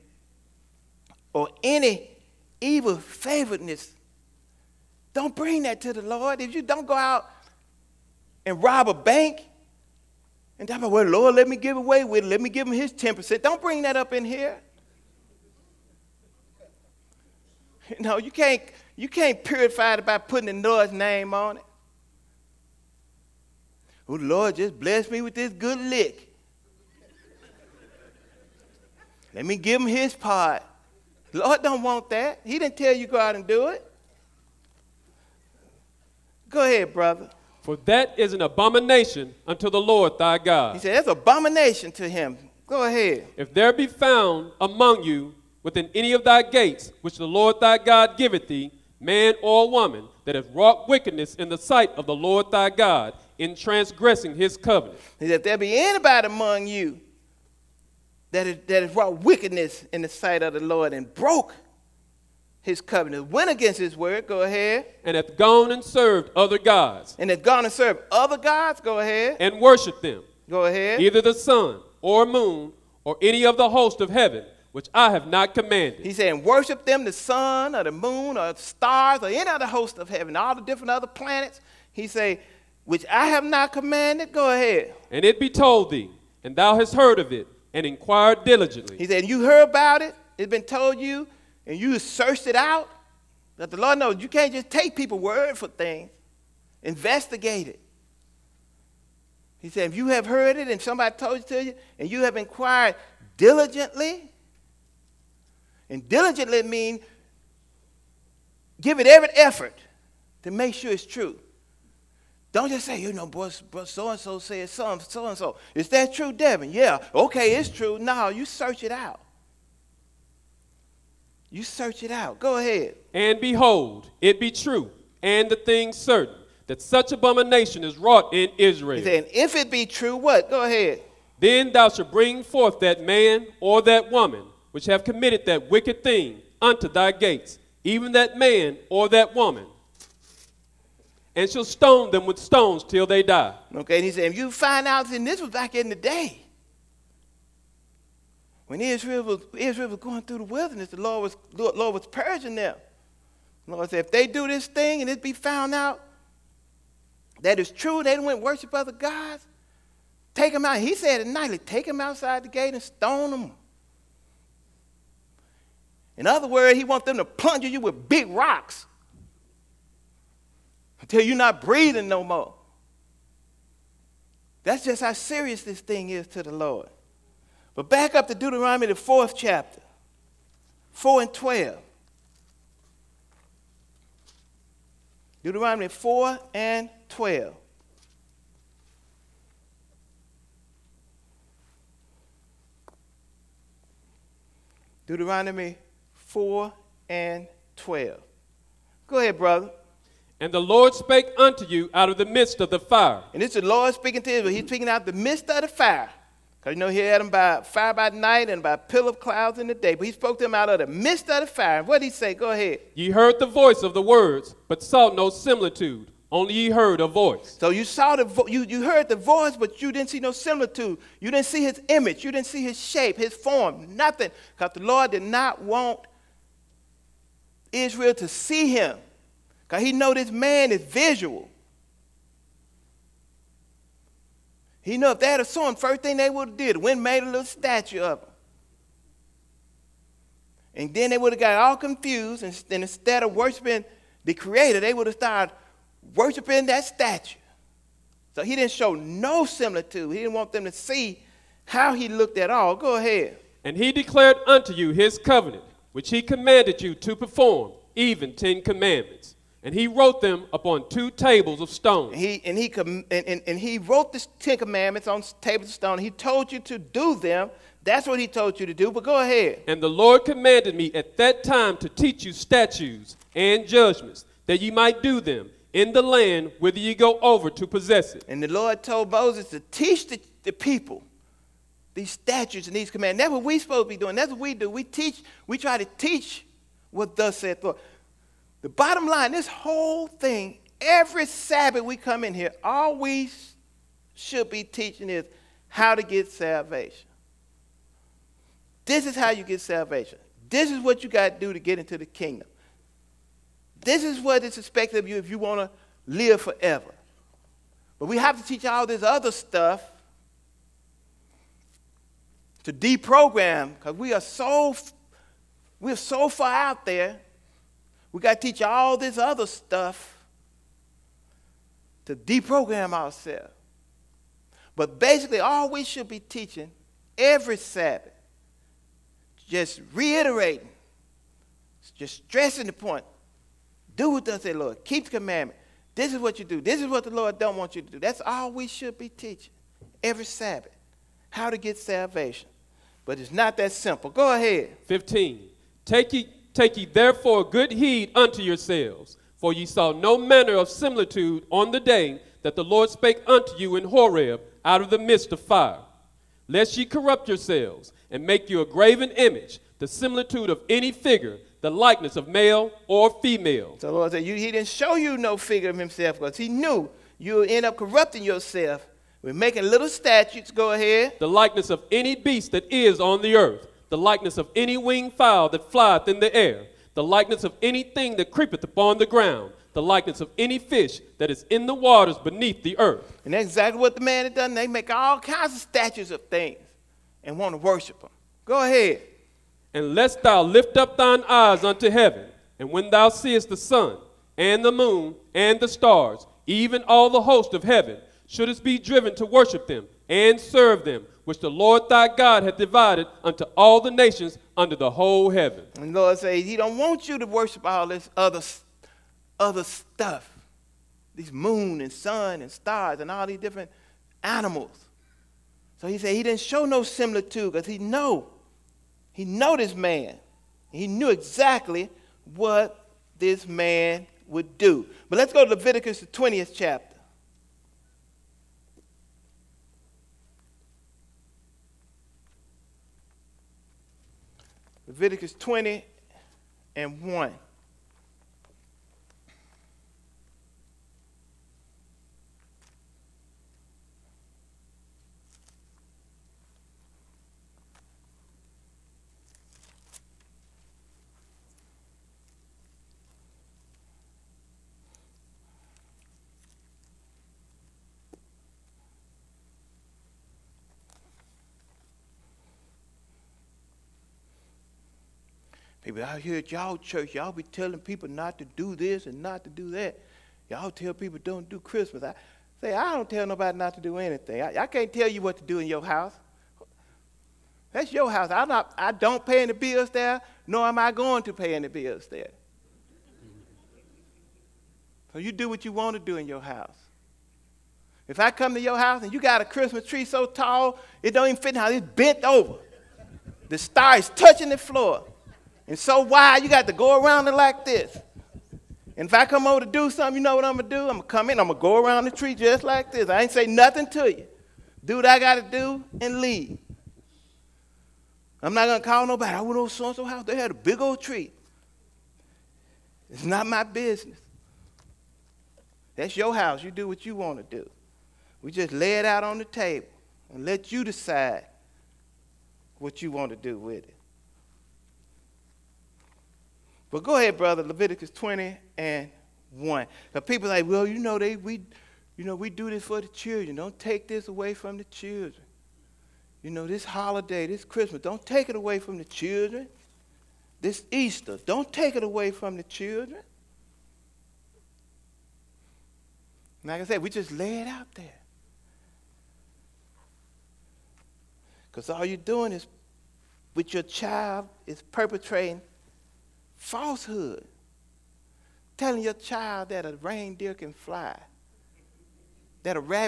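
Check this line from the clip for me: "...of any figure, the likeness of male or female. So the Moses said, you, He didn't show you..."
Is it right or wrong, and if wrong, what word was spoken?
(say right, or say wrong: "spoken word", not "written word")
wrong: "Lord", not "Moses".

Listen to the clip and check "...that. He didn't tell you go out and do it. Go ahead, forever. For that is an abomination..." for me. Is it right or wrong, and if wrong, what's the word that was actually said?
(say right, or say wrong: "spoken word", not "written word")
wrong: "brother", not "forever".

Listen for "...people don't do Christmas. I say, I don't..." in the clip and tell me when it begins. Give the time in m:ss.
7:50.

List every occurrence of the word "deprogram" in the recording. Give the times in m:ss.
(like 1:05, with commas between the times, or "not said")
5:12, 5:22.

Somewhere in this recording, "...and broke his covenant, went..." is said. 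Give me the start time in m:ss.
1:00.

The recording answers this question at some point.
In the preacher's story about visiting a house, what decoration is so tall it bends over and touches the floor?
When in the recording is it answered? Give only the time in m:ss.
8:13.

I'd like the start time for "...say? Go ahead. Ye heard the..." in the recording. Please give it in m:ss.
3:32.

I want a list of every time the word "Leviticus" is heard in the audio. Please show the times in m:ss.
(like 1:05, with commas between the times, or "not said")
7:05, 7:14, 8:47.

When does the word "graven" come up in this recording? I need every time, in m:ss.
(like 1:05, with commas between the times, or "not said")
5:58.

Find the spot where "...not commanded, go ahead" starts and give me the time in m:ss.
1:23.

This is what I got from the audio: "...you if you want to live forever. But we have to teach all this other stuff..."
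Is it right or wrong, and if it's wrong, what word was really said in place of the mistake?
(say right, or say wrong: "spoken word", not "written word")
right.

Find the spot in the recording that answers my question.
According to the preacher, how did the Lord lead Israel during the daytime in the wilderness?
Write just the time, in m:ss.
3:28.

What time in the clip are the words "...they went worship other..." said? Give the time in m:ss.
2:38.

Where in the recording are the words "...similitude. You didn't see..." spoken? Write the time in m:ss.
3:40.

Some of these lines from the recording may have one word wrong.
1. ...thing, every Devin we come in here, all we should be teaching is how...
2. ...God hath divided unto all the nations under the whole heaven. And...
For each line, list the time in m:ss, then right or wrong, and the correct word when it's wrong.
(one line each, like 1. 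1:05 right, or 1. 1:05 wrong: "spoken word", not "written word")
1. 4:50 wrong: "Sabbath", not "Devin"
2. 6:42 right.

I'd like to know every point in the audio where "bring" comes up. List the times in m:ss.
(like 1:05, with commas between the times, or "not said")
0:05, 0:13, 2:12.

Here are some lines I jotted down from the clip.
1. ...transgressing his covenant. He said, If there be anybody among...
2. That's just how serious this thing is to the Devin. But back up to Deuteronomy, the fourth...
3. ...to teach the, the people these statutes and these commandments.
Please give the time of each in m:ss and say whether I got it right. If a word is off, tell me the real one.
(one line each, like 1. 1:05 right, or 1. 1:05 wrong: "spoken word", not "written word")
1. 0:53 right
2. 2:54 wrong: "Lord", not "Devin"
3. 4:39 right.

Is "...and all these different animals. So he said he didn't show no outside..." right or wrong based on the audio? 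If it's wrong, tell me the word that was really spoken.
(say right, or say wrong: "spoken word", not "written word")
wrong: "similitude", not "outside".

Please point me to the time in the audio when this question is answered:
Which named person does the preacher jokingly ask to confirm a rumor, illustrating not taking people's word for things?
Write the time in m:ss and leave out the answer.
1:56.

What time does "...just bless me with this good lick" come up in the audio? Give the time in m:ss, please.
0:24.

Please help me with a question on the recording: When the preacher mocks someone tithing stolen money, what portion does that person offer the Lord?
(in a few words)
10%.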